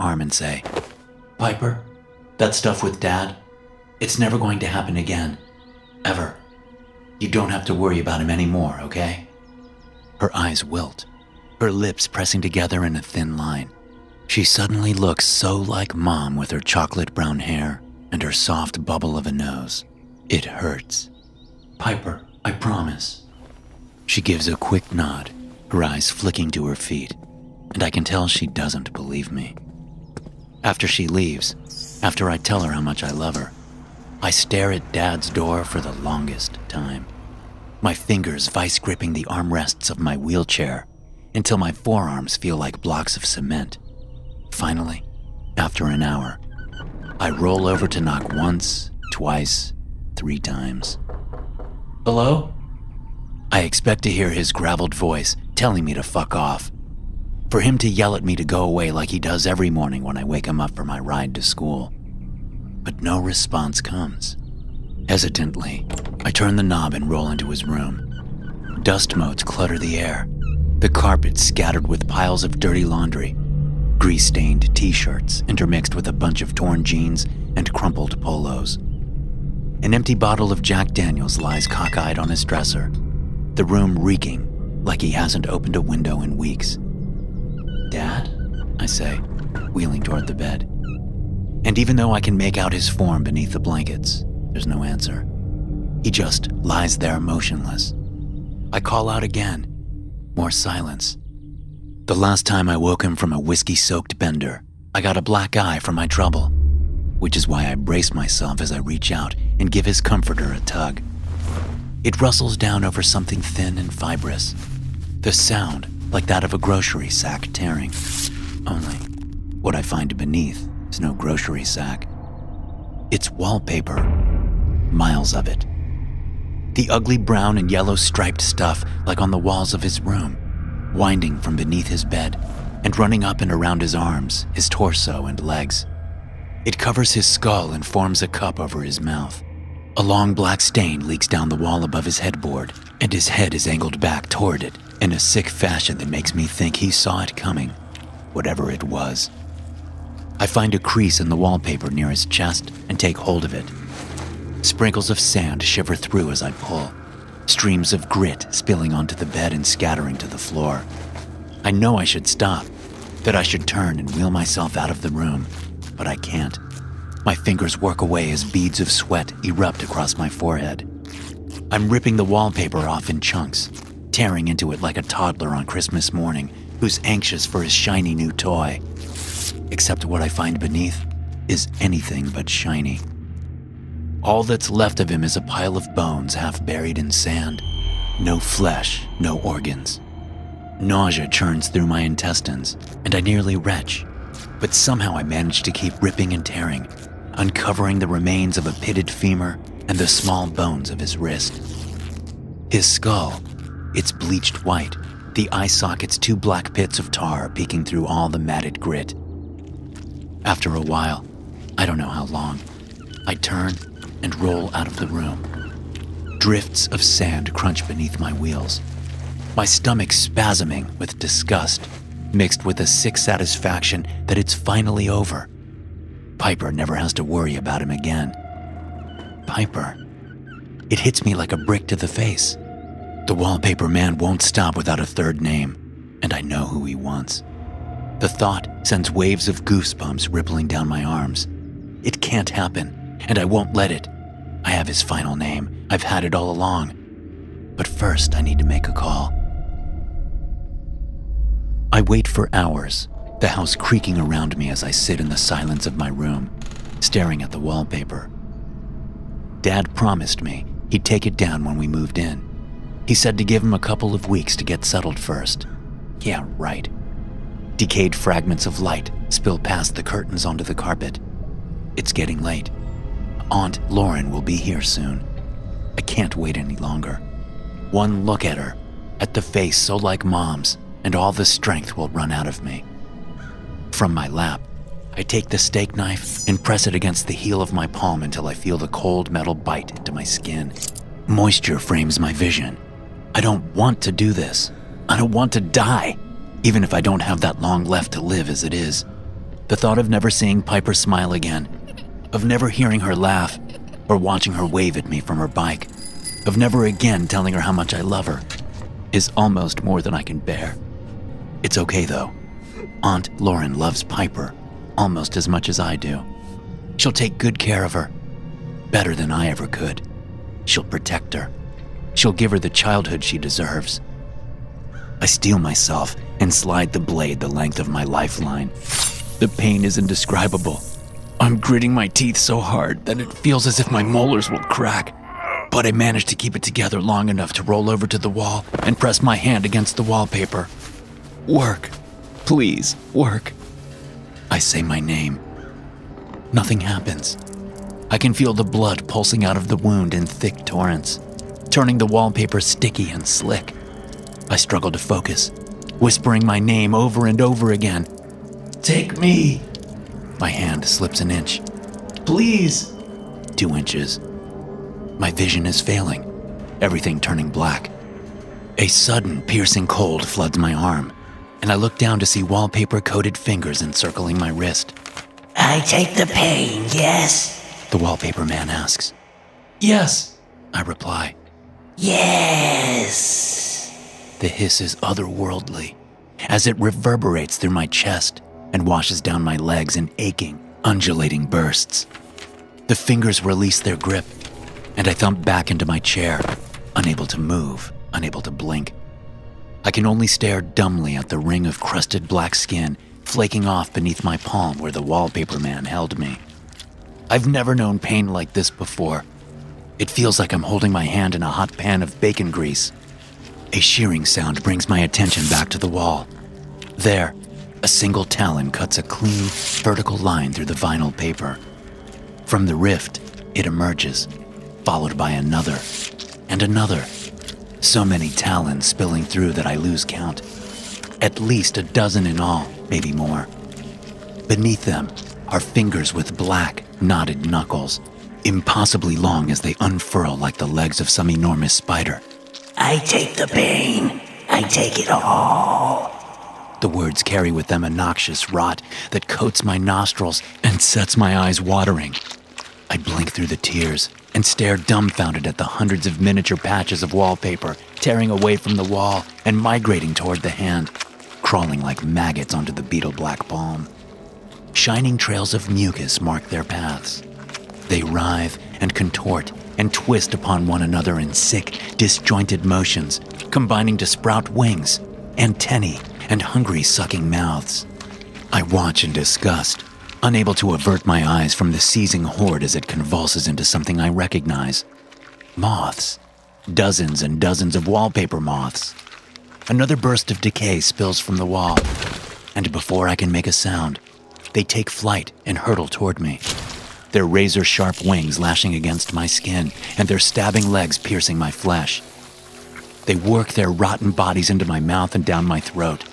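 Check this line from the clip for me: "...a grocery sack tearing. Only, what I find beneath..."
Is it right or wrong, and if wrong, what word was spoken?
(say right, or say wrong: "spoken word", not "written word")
right.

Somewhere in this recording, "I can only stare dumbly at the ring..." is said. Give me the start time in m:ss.
6:39.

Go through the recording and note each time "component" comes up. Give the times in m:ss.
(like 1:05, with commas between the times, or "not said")
not said.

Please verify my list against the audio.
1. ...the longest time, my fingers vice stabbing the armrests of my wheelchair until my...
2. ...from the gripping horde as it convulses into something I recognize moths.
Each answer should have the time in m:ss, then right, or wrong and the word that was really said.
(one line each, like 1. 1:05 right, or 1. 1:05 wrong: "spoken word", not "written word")
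1. 0:35 wrong: "gripping", not "stabbing"
2. 8:01 wrong: "seizing", not "gripping".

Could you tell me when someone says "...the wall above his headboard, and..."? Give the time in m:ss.
2:21.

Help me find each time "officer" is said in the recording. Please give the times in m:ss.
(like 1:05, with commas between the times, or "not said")
not said.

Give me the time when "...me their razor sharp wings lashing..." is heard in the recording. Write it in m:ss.
8:16.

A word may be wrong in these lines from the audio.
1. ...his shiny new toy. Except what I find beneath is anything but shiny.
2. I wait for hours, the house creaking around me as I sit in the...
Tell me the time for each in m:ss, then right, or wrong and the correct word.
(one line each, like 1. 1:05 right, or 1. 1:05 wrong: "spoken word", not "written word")
1. 2:57 right
2. 4:11 right.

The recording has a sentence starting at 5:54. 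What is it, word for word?
I struggled to focus, whispering my name over and over again.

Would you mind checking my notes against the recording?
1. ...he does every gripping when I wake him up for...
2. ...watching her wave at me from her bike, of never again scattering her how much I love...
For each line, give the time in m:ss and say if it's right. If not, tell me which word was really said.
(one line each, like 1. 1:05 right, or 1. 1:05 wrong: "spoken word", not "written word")
1. 0:59 wrong: "morning", not "gripping"
2. 5:04 wrong: "telling", not "scattering".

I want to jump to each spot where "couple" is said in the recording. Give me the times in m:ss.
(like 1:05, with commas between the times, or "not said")
4:23.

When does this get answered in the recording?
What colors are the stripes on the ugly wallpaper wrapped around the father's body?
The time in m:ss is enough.
2:07.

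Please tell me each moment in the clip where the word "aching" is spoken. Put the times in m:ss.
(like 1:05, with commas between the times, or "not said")
6:30.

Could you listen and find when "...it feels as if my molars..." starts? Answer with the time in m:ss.
5:33.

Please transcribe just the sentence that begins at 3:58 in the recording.
The thought sends waves of goosebumps rippling down my arms.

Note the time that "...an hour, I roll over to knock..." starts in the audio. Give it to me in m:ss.
0:45.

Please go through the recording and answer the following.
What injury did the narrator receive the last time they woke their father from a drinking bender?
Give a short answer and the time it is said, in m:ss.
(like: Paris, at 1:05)
A black eye, at 1:45.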